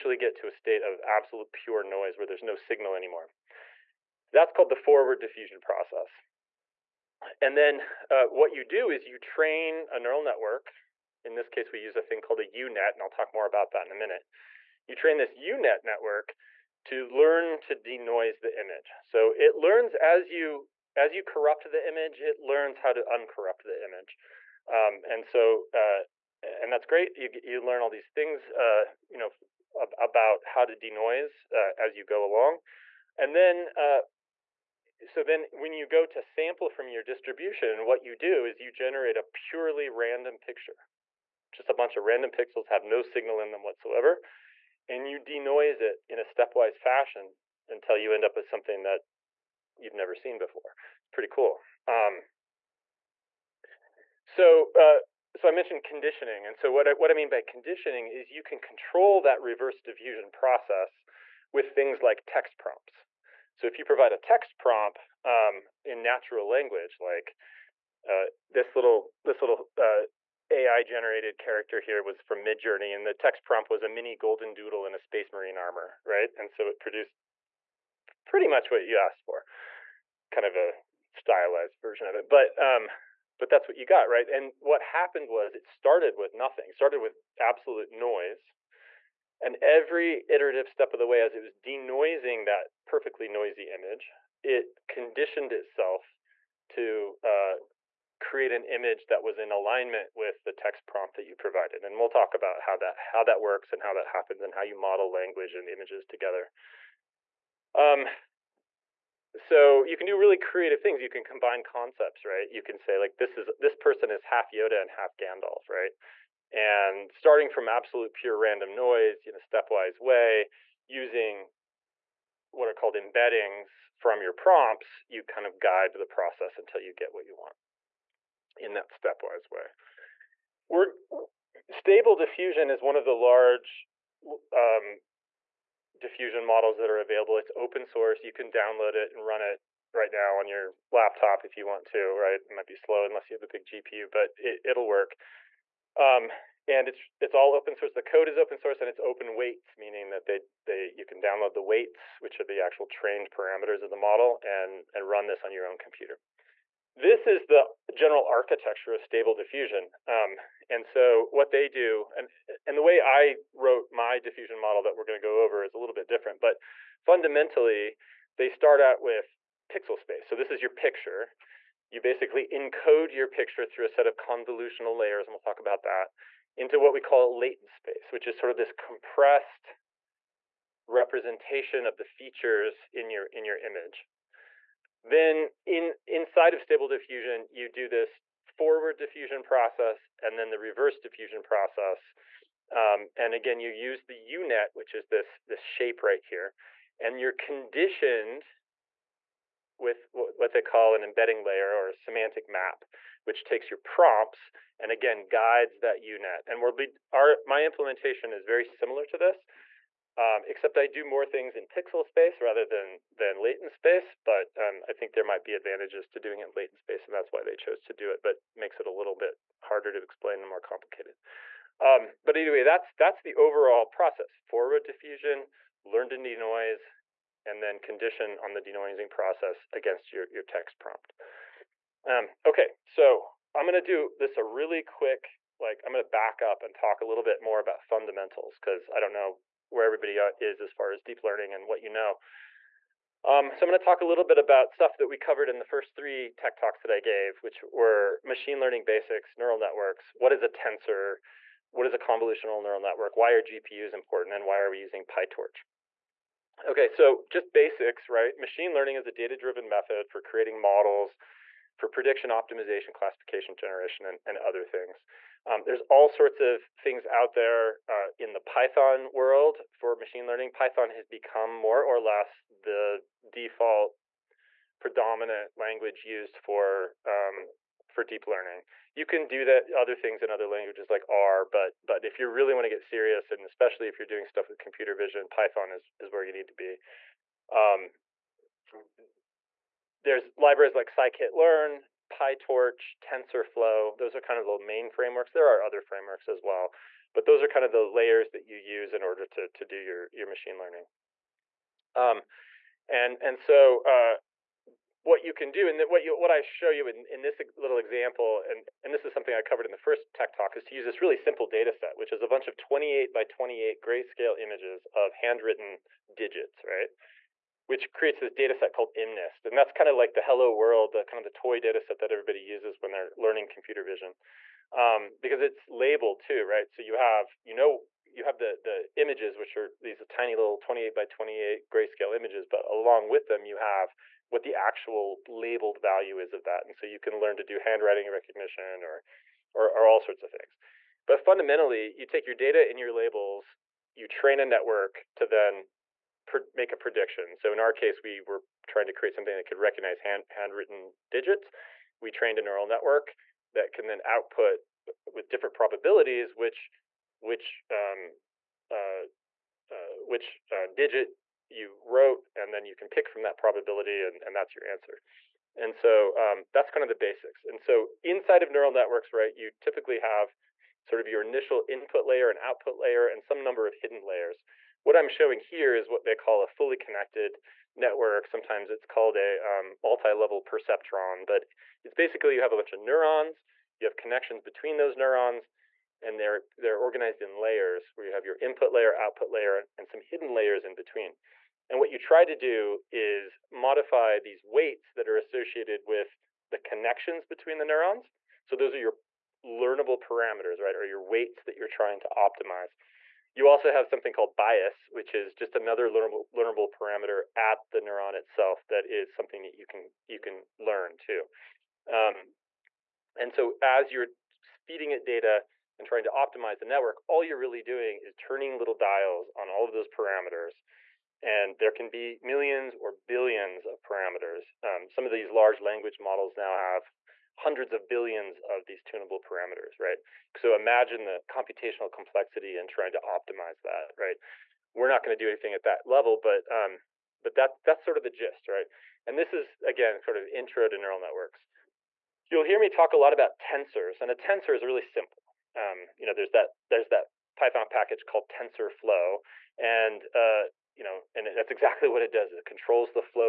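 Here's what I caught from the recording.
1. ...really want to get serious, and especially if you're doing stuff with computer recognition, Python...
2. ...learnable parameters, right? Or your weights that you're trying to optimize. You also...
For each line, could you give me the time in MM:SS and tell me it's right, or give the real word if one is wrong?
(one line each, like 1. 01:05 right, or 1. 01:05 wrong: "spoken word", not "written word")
1. 04:42 wrong: "vision", not "recognition"
2. 06:39 right.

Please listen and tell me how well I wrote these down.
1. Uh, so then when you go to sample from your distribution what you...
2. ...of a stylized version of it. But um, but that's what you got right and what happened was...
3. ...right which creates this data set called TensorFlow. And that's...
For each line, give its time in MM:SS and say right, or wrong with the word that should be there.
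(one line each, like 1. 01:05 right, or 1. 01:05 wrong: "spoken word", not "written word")
1. 00:33 right
2. 01:20 right
3. 05:16 wrong: "MNIST", not "TensorFlow".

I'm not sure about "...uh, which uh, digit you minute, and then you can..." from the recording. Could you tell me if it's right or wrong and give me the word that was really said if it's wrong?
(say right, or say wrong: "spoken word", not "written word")
wrong: "wrote", not "minute".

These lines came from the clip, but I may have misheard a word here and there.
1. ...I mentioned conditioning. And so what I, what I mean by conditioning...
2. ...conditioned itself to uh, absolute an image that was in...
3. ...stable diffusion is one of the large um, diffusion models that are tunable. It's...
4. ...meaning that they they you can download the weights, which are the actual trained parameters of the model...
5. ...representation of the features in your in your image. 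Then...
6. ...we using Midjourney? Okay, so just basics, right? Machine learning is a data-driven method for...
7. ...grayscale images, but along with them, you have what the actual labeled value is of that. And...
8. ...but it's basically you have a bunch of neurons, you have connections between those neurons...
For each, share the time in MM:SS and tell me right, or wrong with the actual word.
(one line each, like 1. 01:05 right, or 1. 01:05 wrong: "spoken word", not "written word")
1. 00:55 right
2. 01:34 wrong: "create", not "absolute"
3. 02:11 wrong: "available", not "tunable"
4. 02:29 right
5. 03:00 right
6. 04:14 wrong: "PyTorch", not "Midjourney"
7. 05:31 right
8. 06:21 right.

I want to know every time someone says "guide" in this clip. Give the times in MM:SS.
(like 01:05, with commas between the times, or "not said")
02:05, 03:25.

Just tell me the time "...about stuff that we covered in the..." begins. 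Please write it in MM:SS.
04:04.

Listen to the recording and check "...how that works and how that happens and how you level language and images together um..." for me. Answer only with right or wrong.
wrong.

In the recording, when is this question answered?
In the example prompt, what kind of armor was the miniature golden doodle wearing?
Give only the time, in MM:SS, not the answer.
01:14.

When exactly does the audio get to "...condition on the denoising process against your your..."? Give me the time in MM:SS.
03:47.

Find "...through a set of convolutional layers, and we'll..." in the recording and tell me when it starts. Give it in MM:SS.
02:53.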